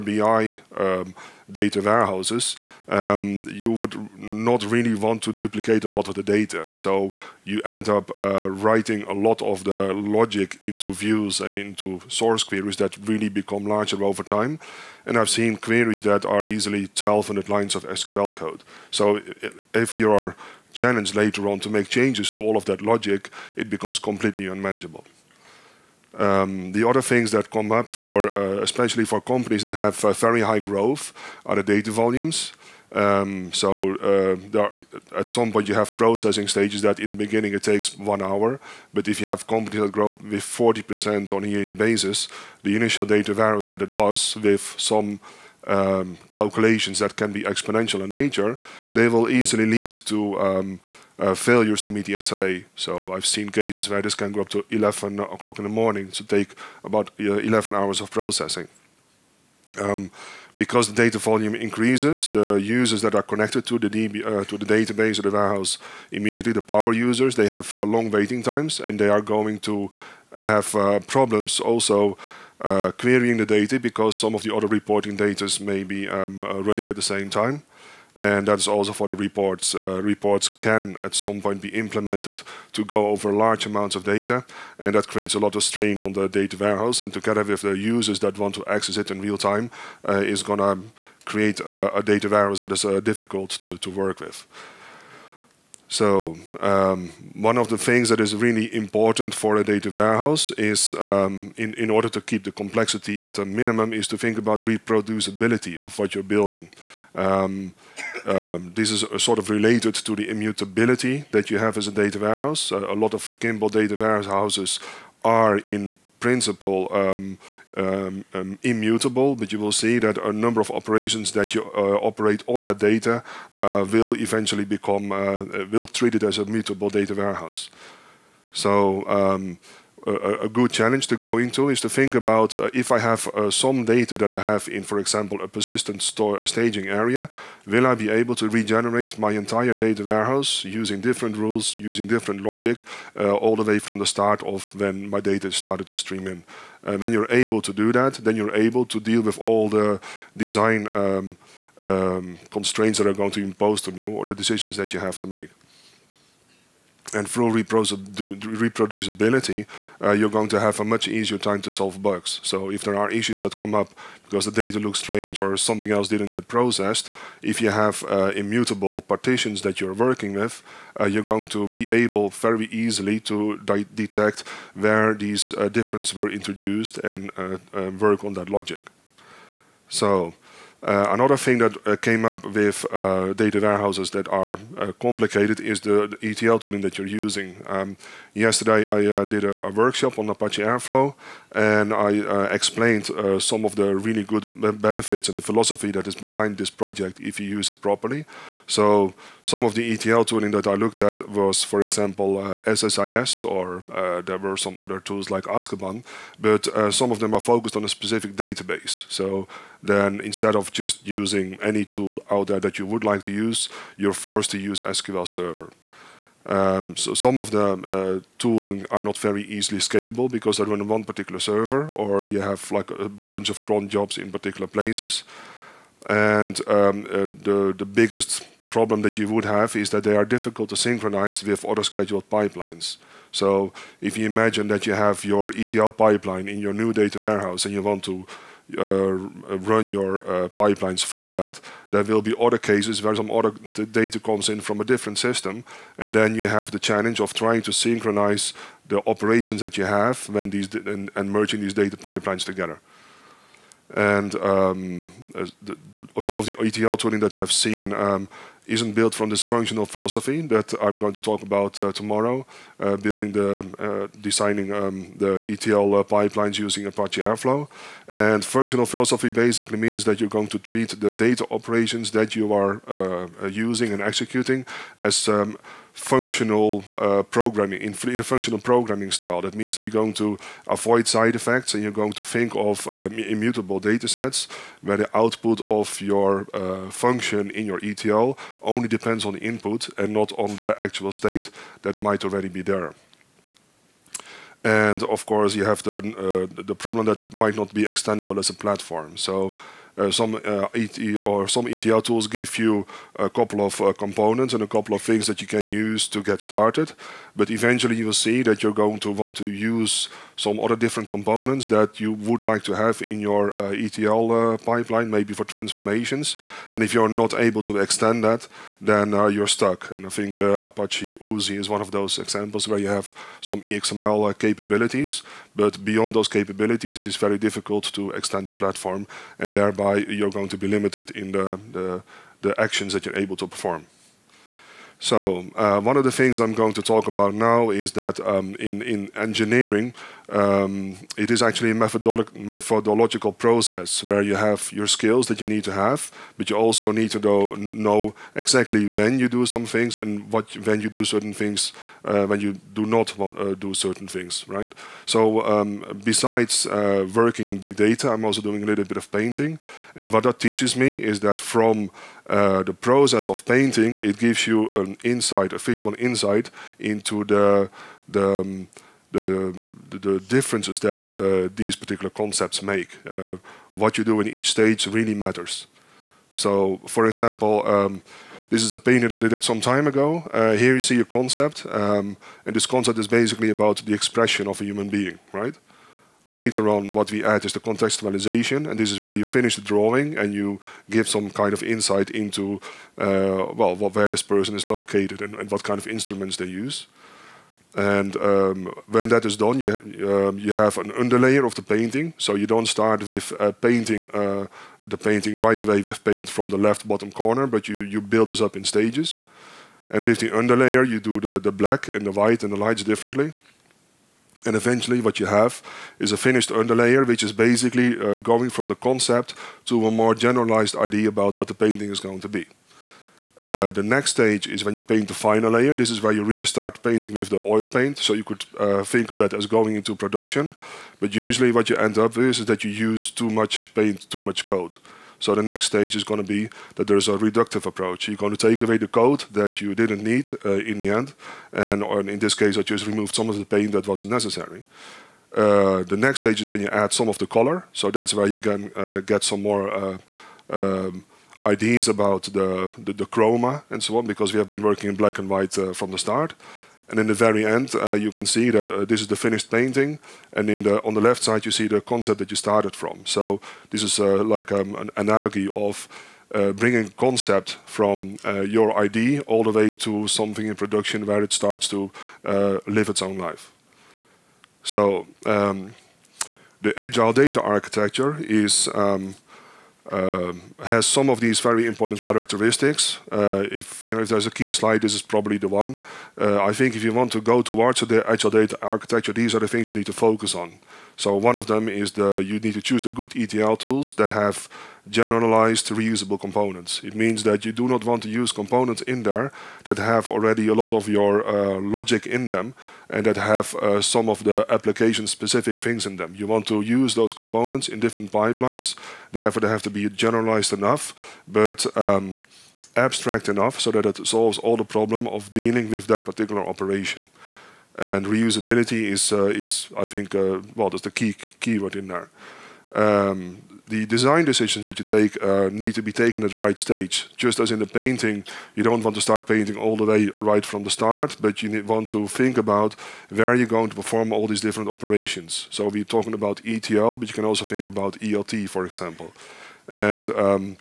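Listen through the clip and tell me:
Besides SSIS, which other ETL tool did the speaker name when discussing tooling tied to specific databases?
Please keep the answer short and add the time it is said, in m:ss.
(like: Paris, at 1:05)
Azkaban, at 3:25.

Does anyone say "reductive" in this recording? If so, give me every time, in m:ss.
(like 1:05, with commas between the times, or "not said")
7:17.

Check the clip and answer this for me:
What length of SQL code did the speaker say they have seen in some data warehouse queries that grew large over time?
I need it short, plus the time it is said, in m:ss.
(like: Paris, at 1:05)
1,200 lines, at 0:16.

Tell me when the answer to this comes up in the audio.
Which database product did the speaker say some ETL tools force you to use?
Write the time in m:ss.
3:34.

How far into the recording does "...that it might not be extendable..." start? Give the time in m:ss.
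4:57.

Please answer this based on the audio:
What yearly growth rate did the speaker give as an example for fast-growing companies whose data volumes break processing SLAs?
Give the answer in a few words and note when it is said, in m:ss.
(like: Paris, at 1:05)
40%, at 0:40.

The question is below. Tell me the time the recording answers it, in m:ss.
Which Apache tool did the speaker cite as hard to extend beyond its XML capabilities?
5:20.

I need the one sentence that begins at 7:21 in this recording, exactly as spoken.
And in this case, I just removed some of the paint that wasn't necessary.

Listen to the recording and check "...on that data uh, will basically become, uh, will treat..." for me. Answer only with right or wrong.
wrong.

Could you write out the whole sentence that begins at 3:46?
And um, uh, the the biggest problem that you would have is that they are difficult to synchronize with other scheduled pipelines.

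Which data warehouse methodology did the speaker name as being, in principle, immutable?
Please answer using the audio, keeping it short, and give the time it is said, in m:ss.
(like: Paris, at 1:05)
Kimball, at 1:53.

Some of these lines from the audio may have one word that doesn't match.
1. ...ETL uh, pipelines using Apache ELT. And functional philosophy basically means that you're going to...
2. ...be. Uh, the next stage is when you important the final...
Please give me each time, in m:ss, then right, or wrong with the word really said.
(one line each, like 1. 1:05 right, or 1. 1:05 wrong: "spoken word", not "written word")
1. 4:25 wrong: "Airflow", not "ELT"
2. 7:02 wrong: "paint", not "important".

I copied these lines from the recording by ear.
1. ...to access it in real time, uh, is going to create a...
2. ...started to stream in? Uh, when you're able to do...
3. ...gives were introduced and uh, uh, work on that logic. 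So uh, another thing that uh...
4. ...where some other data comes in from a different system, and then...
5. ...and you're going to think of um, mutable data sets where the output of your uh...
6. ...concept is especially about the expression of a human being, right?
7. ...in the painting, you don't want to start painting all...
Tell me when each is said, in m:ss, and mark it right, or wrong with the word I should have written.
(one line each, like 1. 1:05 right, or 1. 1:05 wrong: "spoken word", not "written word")
1. 1:28 right
2. 2:25 right
3. 2:55 wrong: "differences", not "gives"
4. 4:03 right
5. 4:41 wrong: "immutable", not "mutable"
6. 6:22 wrong: "basically", not "especially"
7. 8:47 right.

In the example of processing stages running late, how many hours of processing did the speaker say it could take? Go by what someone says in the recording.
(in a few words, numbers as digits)
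11 hours.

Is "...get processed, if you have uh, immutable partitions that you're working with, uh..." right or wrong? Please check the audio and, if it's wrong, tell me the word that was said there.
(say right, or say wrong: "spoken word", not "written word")
right.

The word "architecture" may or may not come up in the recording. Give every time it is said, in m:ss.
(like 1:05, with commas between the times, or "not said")
7:57, 8:08.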